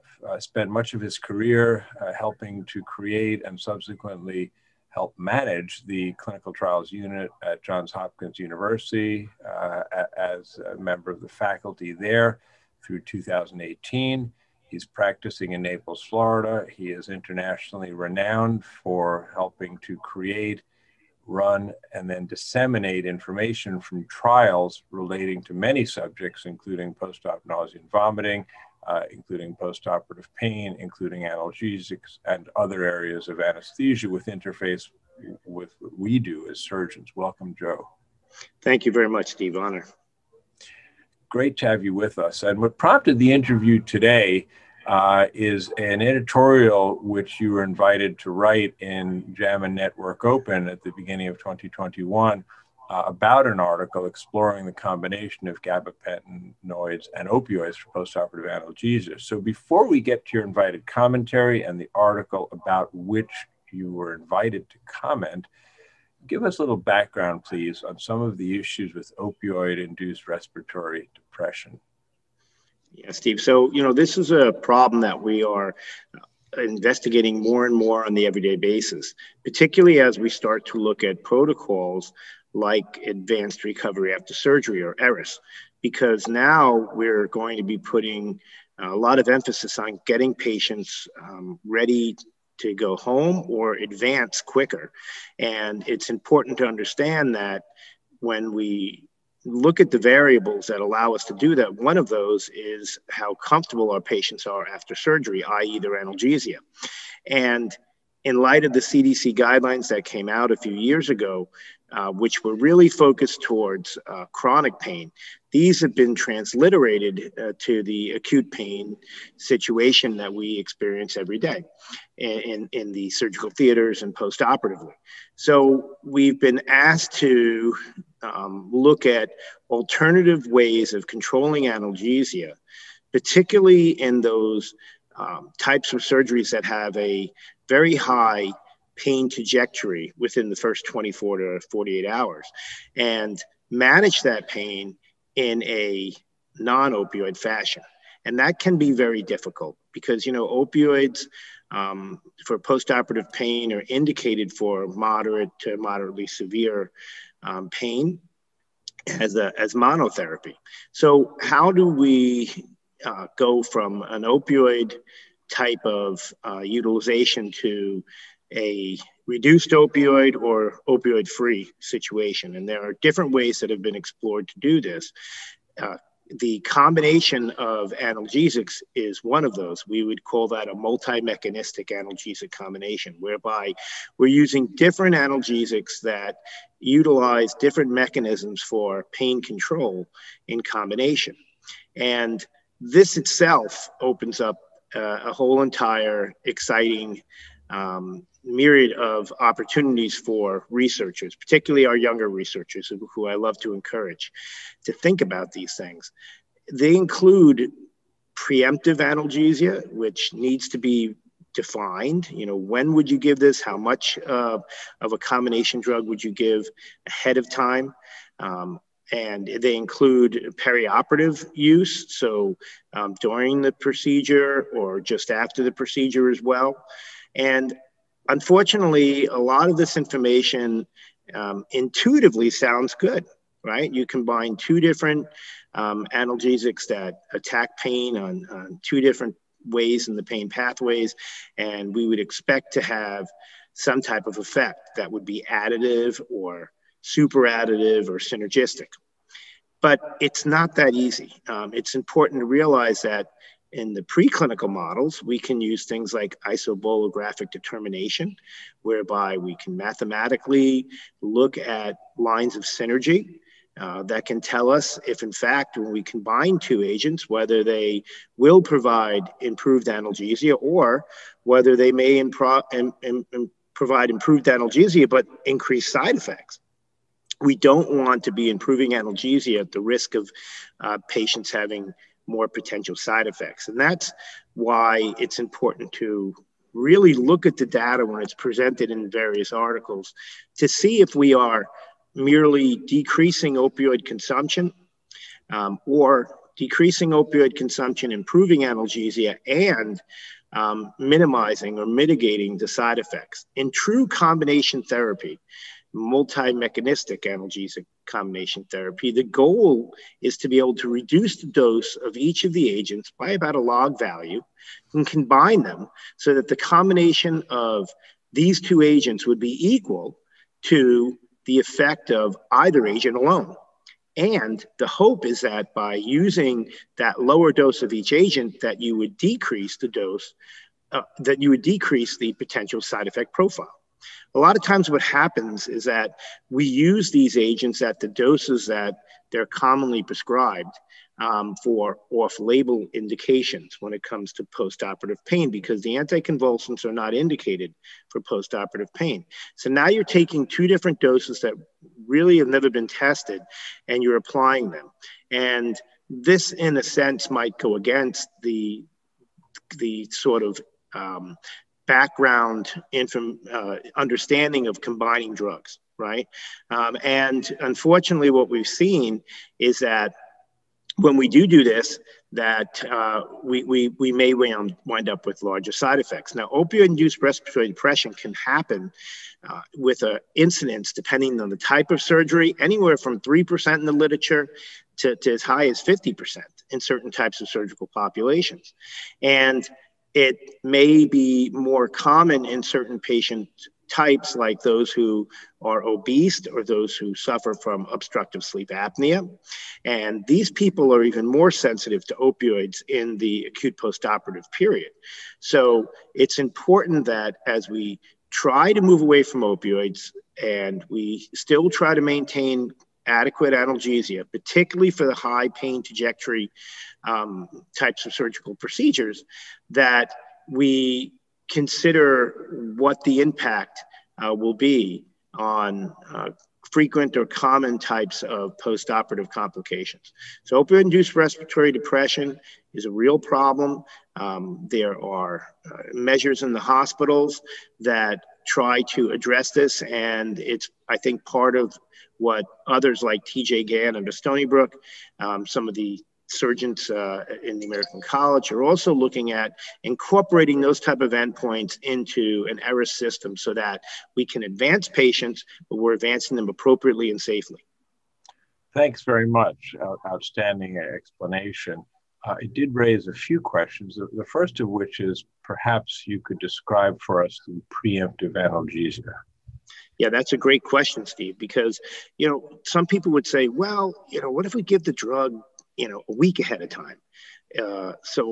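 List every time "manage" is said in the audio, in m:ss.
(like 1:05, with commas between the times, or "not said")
0:05, 2:23.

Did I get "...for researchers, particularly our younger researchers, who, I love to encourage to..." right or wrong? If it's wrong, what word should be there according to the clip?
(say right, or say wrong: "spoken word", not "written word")
right.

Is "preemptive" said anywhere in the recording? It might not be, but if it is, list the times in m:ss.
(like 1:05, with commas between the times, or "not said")
3:28, 7:47.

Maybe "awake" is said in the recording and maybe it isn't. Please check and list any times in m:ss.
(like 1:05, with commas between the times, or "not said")
not said.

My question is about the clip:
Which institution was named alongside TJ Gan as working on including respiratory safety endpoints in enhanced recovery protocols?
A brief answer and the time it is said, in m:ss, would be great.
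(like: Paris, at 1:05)
Stony Brook, at 7:24.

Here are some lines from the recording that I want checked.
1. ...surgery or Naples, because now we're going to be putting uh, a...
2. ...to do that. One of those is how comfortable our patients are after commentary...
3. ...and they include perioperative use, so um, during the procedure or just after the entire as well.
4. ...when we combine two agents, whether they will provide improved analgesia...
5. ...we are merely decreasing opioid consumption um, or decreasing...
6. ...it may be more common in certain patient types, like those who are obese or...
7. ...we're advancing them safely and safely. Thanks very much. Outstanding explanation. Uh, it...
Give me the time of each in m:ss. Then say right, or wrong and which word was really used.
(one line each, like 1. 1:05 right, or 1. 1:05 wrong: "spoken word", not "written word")
1. 1:24 wrong: "ERAS", not "Naples"
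2. 1:41 wrong: "surgery", not "commentary"
3. 3:39 wrong: "procedure", not "entire"
4. 4:25 right
5. 4:51 right
6. 6:30 right
7. 7:35 wrong: "appropriately", not "safely".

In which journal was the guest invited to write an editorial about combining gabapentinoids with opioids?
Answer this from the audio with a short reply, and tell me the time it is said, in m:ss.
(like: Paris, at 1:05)
JAMA Network Open, at 0:49.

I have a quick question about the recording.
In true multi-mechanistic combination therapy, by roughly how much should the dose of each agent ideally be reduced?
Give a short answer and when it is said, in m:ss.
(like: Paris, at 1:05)
About a log value, at 5:13.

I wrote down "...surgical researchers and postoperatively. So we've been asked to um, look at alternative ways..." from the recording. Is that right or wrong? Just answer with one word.
wrong.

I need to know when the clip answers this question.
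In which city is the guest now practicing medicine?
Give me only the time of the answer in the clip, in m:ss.
0:15.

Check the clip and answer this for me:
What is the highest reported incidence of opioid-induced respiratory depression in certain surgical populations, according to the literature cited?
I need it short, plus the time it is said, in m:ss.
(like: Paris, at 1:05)
50%, at 6:25.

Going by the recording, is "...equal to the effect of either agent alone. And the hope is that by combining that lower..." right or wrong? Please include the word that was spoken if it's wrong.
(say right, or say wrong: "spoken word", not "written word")
wrong: "using", not "combining".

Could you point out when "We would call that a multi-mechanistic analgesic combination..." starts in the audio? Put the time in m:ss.
2:59.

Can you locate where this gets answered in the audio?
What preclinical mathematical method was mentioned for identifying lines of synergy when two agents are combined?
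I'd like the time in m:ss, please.
4:16.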